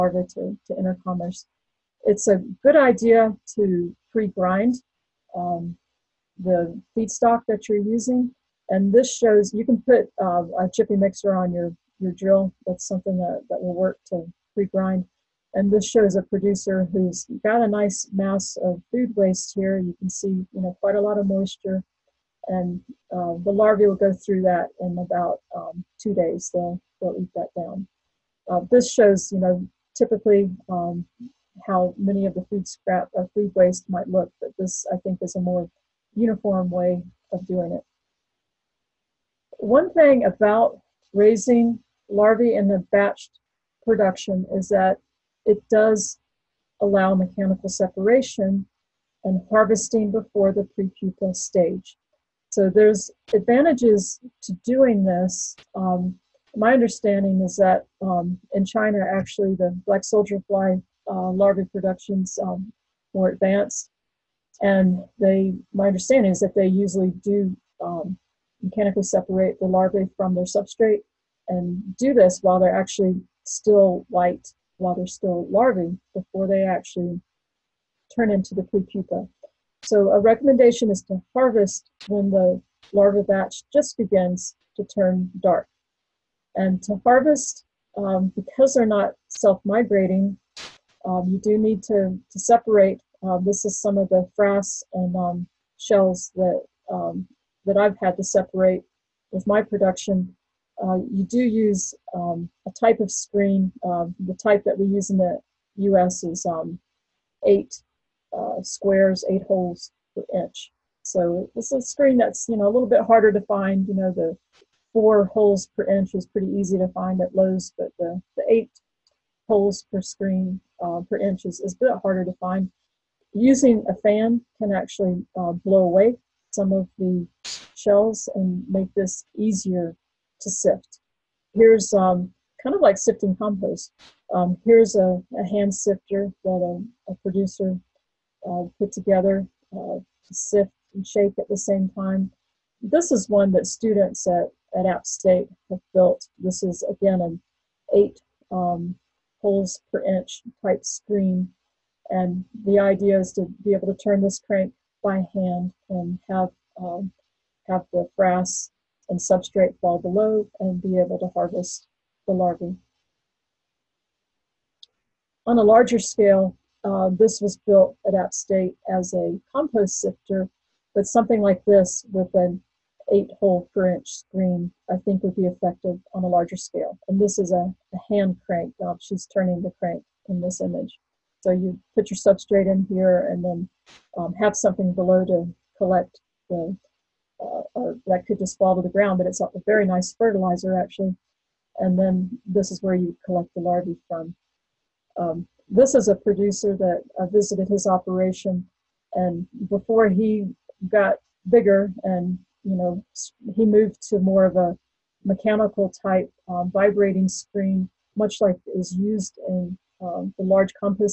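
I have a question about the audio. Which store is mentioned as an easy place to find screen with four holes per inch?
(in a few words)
Lowe's.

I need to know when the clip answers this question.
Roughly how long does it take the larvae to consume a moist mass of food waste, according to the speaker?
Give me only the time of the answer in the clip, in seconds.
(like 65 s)
25 s.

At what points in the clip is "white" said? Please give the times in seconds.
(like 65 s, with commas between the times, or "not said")
74 s.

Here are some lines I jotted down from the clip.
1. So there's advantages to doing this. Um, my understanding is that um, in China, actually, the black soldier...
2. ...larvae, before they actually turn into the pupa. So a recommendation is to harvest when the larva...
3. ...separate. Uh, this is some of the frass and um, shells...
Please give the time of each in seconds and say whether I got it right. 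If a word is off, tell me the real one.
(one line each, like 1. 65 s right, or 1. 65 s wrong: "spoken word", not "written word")
1. 52 s right
2. 75 s right
3. 92 s right.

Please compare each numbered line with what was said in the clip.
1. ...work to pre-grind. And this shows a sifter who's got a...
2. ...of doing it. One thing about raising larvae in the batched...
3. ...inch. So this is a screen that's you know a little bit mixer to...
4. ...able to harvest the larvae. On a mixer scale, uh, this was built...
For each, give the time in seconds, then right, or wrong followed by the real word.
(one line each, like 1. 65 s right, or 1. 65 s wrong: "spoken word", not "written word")
1. 13 s wrong: "producer", not "sifter"
2. 37 s right
3. 110 s wrong: "harder", not "mixer"
4. 160 s wrong: "larger", not "mixer".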